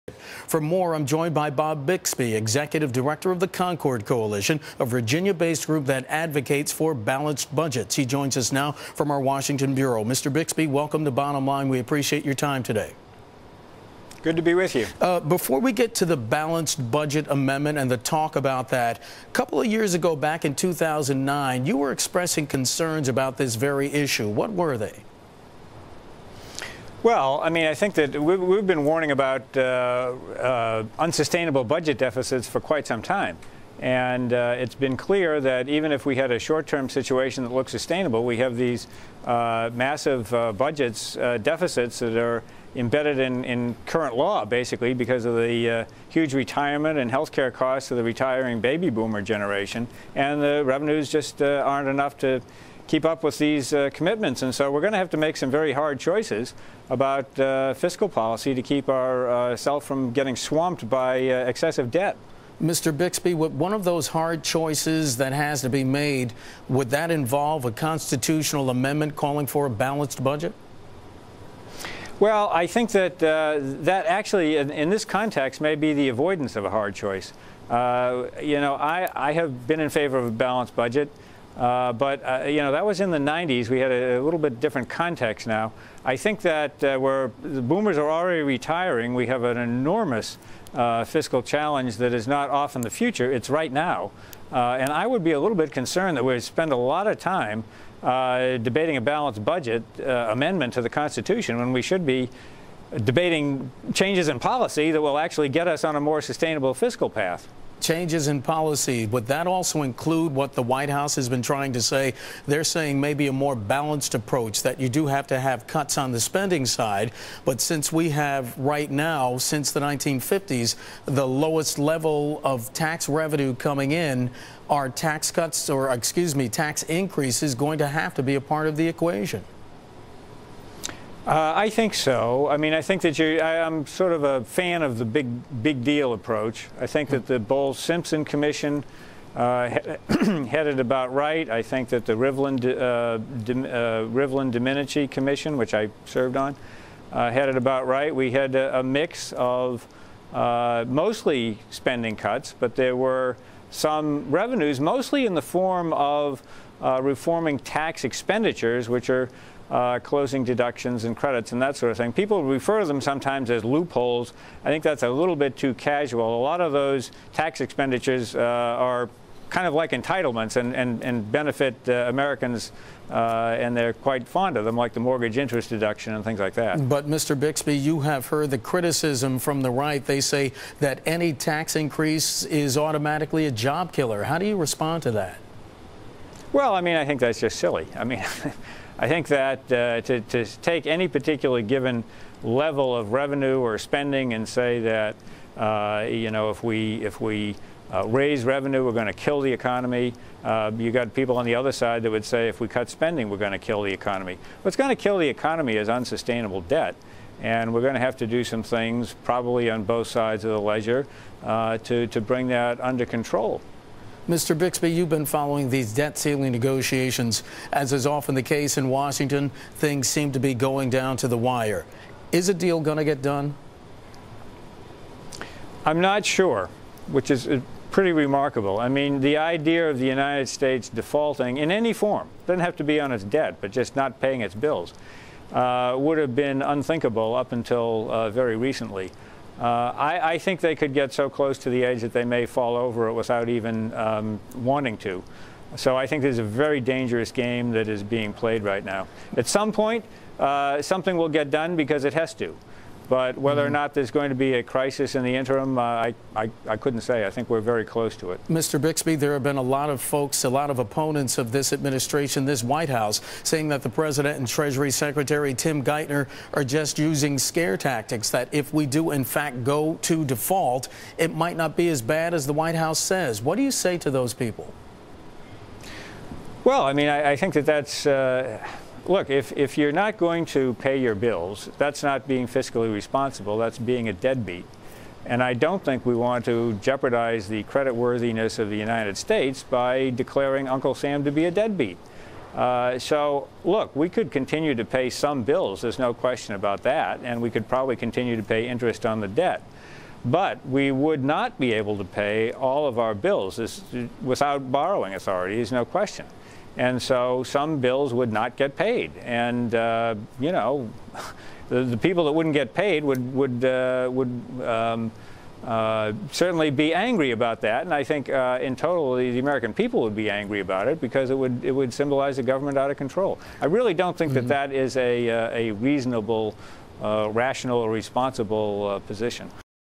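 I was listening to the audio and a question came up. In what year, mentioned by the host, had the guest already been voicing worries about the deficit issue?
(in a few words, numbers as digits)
2009.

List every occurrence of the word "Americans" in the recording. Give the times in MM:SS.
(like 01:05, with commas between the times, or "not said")
02:52, 05:19.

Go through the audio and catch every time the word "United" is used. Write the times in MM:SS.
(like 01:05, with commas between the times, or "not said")
03:50, 04:48.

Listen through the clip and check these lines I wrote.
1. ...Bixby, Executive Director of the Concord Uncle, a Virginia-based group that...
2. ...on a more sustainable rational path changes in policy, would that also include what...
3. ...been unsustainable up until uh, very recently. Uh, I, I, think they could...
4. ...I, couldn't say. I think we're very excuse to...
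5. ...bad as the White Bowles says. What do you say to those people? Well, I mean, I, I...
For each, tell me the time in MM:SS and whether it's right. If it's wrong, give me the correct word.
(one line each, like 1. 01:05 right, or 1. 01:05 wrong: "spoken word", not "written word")
1. 00:01 wrong: "Coalition", not "Uncle"
2. 01:45 wrong: "fiscal", not "rational"
3. 03:56 wrong: "unthinkable", not "unsustainable"
4. 04:16 wrong: "close", not "excuse"
5. 04:32 wrong: "House", not "Bowles".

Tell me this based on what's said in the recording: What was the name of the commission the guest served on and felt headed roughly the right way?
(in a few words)
Rivlin Domenici Commission.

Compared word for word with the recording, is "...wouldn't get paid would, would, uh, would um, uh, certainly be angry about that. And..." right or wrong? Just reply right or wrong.
right.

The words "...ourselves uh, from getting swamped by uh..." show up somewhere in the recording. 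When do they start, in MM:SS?
00:58.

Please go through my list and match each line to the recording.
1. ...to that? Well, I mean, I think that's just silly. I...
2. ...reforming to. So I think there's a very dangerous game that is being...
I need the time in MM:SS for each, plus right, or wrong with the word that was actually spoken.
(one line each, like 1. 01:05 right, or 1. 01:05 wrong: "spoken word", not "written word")
1. 03:05 right
2. 04:04 wrong: "wanting", not "reforming".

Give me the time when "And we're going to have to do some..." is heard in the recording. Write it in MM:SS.
03:27.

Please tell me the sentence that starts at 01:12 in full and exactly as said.
Well, I think that uh, that actually, in, in, this context, may be the avoidance of a hard choice.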